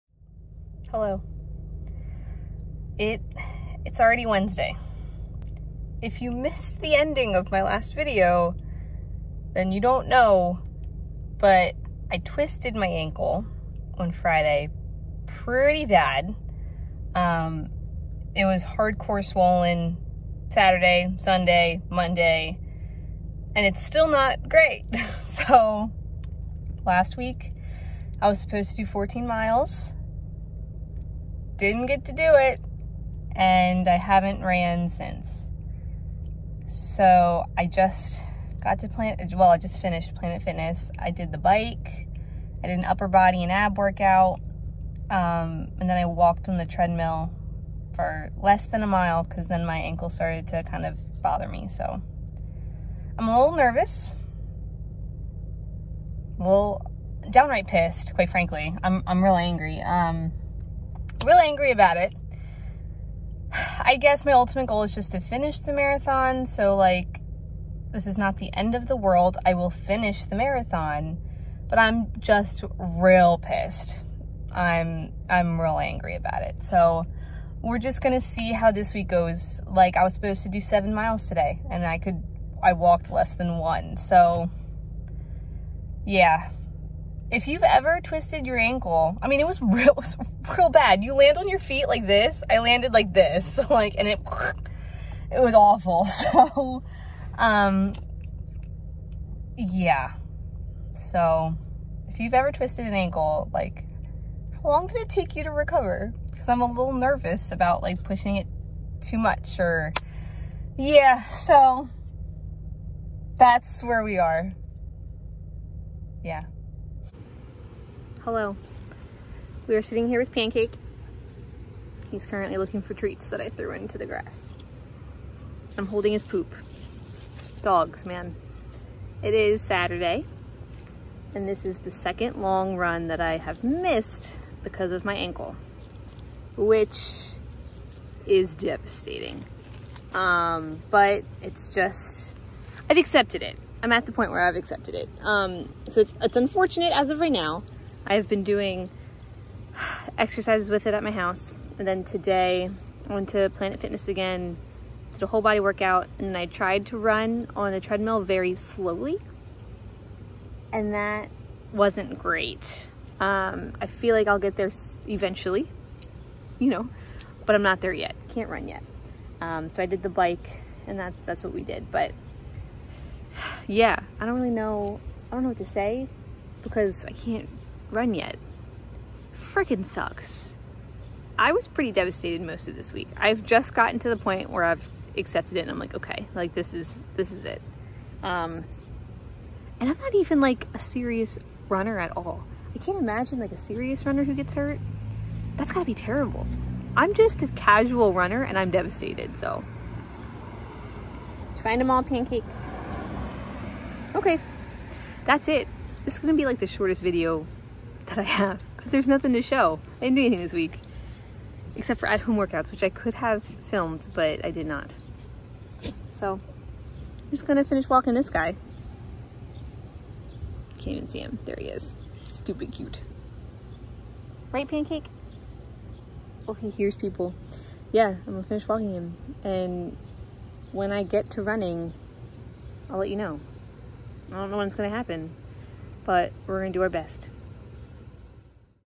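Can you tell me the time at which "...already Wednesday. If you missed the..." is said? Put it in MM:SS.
00:04.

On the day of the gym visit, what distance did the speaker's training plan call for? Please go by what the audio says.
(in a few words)
7 miles.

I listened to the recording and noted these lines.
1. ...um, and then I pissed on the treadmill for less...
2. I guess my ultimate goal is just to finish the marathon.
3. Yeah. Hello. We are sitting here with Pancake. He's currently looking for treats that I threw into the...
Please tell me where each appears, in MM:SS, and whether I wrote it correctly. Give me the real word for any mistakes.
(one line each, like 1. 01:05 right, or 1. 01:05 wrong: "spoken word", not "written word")
1. 00:45 wrong: "walked", not "pissed"
2. 01:03 right
3. 01:56 right.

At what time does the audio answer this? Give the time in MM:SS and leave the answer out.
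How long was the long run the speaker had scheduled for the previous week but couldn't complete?
00:28.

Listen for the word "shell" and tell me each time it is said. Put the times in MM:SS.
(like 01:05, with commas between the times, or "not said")
not said.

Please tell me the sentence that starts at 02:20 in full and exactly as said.
Um, but it's just, I've accepted it.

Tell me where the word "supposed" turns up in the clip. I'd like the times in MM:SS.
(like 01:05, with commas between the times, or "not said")
00:28, 01:20.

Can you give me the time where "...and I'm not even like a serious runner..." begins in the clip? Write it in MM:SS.
03:09.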